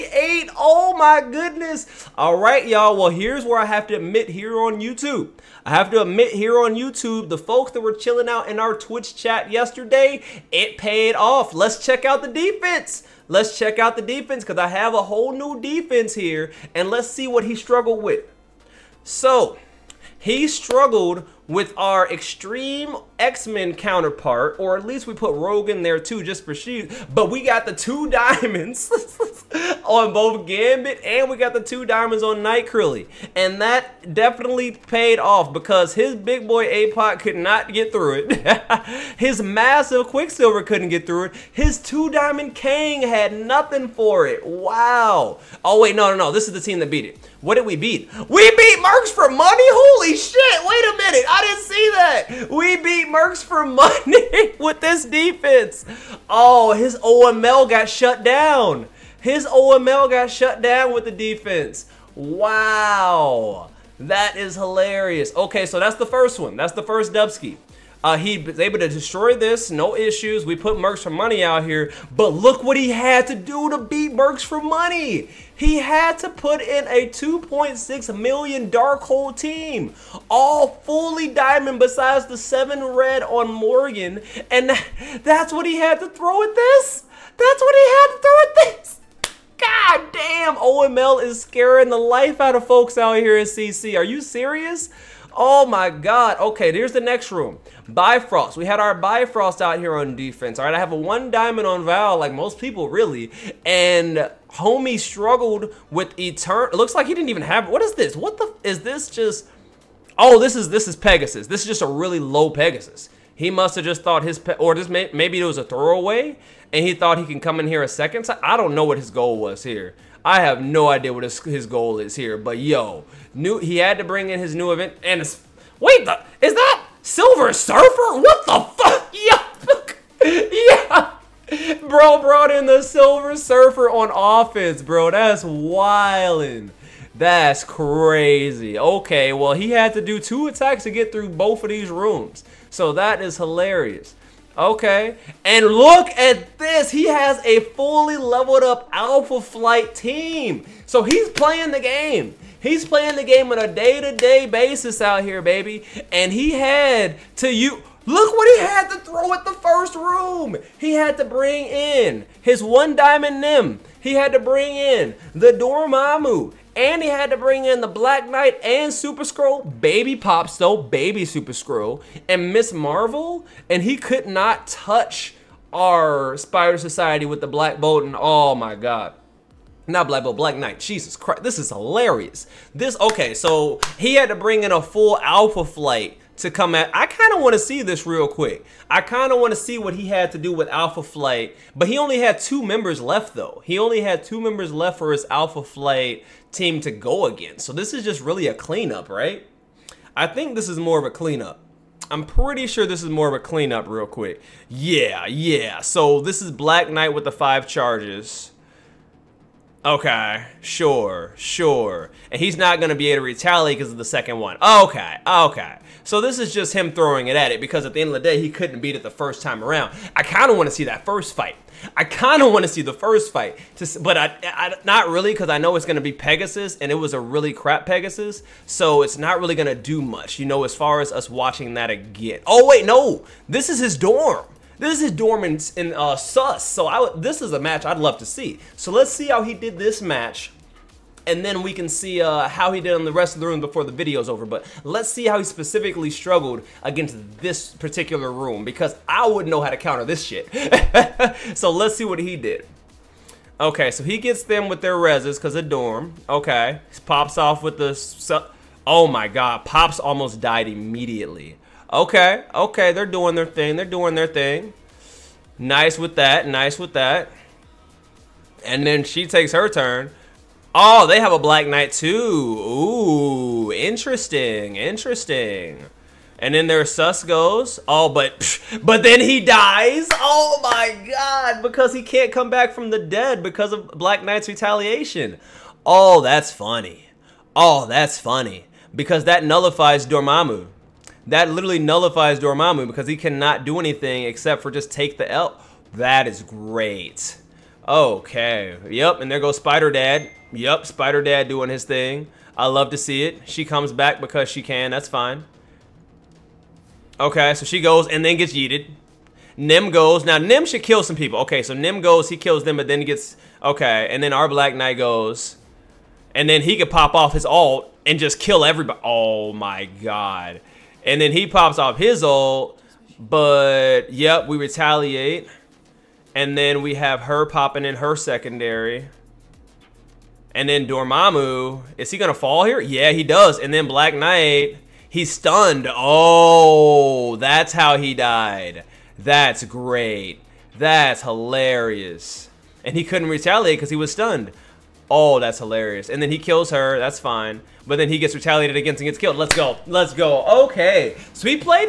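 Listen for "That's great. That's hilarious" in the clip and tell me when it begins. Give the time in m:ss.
5:39.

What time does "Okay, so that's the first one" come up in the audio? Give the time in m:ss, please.
1:05.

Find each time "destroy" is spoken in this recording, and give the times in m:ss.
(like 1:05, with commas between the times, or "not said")
1:08.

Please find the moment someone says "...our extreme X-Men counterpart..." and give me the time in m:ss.
0:21.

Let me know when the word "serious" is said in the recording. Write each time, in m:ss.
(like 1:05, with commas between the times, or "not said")
1:34.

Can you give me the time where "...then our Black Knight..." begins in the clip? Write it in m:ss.
5:14.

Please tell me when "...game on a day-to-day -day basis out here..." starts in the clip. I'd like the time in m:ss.
2:33.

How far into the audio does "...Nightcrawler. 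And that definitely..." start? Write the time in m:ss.
0:32.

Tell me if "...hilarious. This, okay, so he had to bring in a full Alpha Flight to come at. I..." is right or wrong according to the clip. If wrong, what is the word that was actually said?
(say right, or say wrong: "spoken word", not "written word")
right.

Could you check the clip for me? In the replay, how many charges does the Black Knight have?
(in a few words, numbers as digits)
5.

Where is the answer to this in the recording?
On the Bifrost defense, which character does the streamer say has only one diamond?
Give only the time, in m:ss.
1:41.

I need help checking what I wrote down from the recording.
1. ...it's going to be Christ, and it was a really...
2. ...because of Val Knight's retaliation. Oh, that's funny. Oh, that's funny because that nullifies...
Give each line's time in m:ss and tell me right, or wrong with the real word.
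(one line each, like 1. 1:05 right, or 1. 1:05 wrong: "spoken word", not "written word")
1. 3:45 wrong: "Pegasus", not "Christ"
2. 4:43 wrong: "Black", not "Val".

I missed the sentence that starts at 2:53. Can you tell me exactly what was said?
And he could not touch our Spider Society with the Black Bolt.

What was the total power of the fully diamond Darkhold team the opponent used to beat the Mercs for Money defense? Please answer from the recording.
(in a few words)
2.6 million.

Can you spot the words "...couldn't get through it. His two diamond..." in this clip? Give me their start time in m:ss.
0:40.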